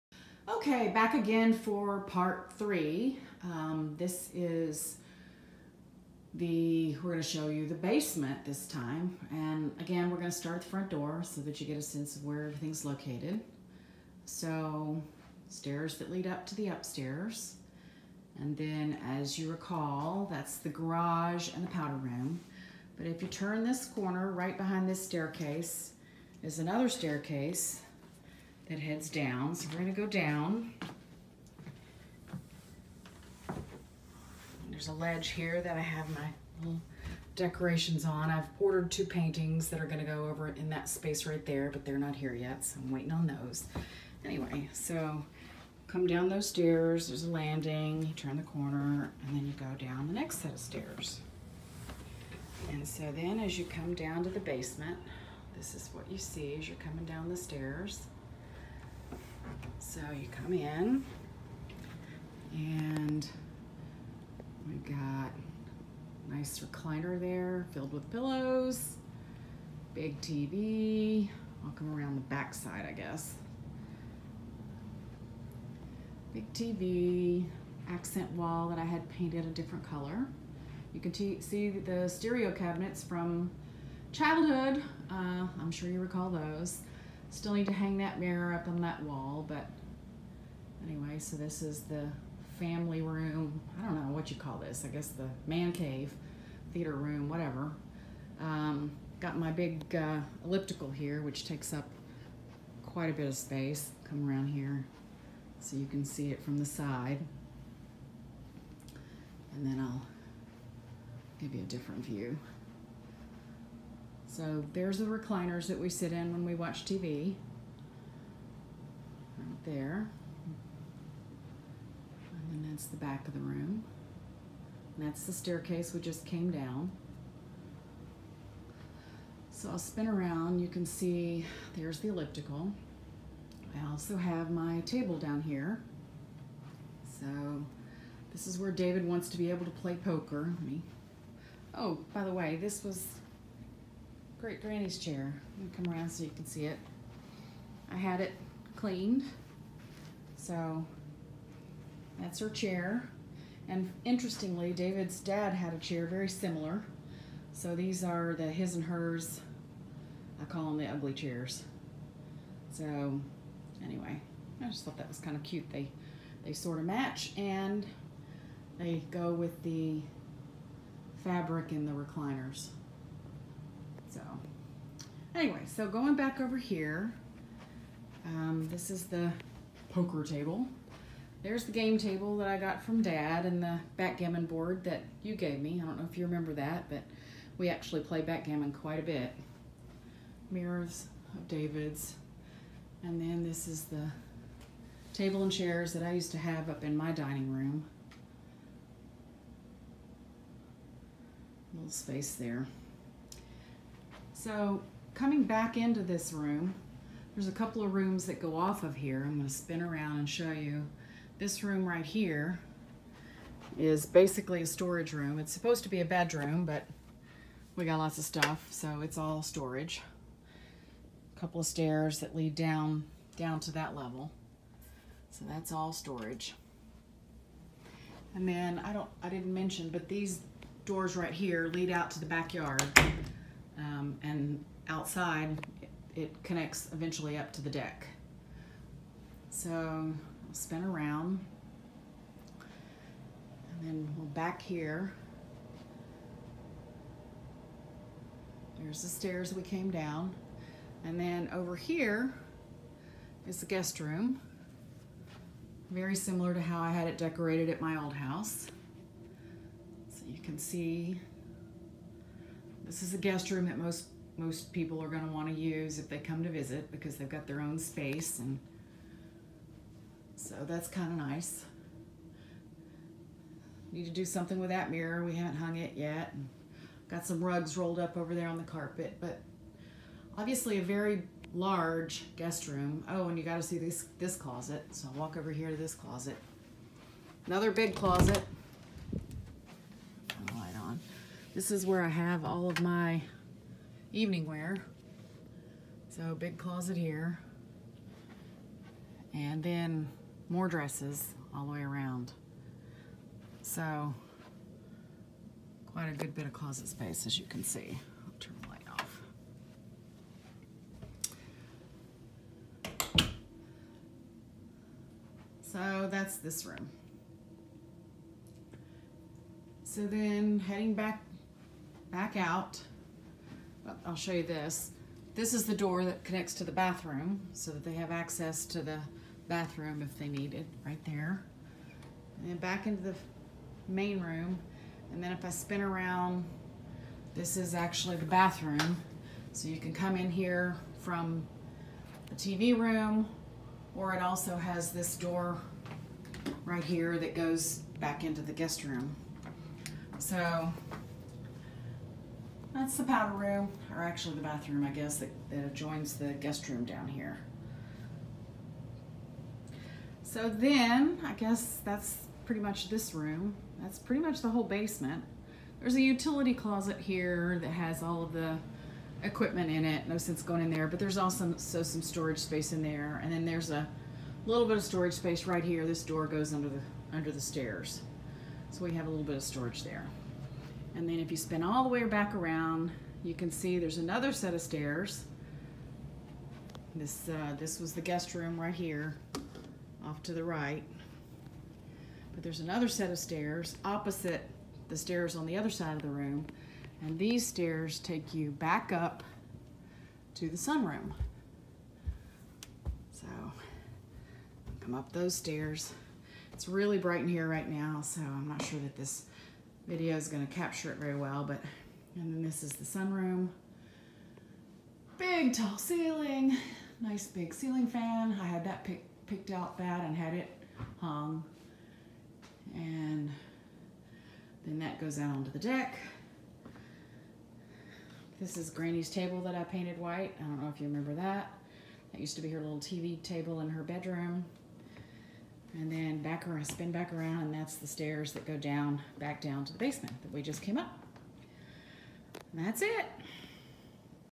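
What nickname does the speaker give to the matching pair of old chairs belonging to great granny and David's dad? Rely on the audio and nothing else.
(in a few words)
the ugly chairs.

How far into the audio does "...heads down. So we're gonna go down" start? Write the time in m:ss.
0:28.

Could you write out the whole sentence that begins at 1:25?
Uh, I'm sure you recall those.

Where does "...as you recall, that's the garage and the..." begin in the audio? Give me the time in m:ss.
0:19.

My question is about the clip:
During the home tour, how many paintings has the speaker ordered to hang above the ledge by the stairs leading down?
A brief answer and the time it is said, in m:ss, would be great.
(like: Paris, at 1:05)
2, at 0:38.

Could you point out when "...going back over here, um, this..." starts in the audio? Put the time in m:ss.
2:55.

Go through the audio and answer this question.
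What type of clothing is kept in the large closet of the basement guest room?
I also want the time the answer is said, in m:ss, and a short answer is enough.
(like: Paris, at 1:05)
evening wear, at 4:54.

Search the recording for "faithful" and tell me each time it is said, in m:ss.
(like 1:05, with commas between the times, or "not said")
not said.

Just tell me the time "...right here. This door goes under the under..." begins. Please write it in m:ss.
6:15.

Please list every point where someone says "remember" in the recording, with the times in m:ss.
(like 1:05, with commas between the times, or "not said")
3:06, 7:10.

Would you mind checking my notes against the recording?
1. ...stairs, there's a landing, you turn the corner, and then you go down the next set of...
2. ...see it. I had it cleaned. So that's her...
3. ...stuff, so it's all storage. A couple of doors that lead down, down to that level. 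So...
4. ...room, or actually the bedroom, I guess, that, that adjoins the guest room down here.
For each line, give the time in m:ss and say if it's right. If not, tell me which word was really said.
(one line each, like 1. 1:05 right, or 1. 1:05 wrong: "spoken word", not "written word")
1. 0:46 right
2. 2:26 right
3. 3:38 wrong: "stairs", not "doors"
4. 5:53 wrong: "bathroom", not "bedroom".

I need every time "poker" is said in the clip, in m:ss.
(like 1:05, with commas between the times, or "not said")
2:19, 2:59.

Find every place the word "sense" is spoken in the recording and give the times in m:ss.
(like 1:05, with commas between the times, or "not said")
0:11, 6:10.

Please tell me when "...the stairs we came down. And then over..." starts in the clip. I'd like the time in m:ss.
4:09.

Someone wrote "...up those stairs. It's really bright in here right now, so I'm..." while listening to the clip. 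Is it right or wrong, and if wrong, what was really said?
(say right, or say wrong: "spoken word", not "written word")
right.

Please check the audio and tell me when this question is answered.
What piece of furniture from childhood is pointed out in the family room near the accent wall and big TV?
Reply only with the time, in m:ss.
1:22.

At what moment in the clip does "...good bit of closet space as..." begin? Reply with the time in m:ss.
5:06.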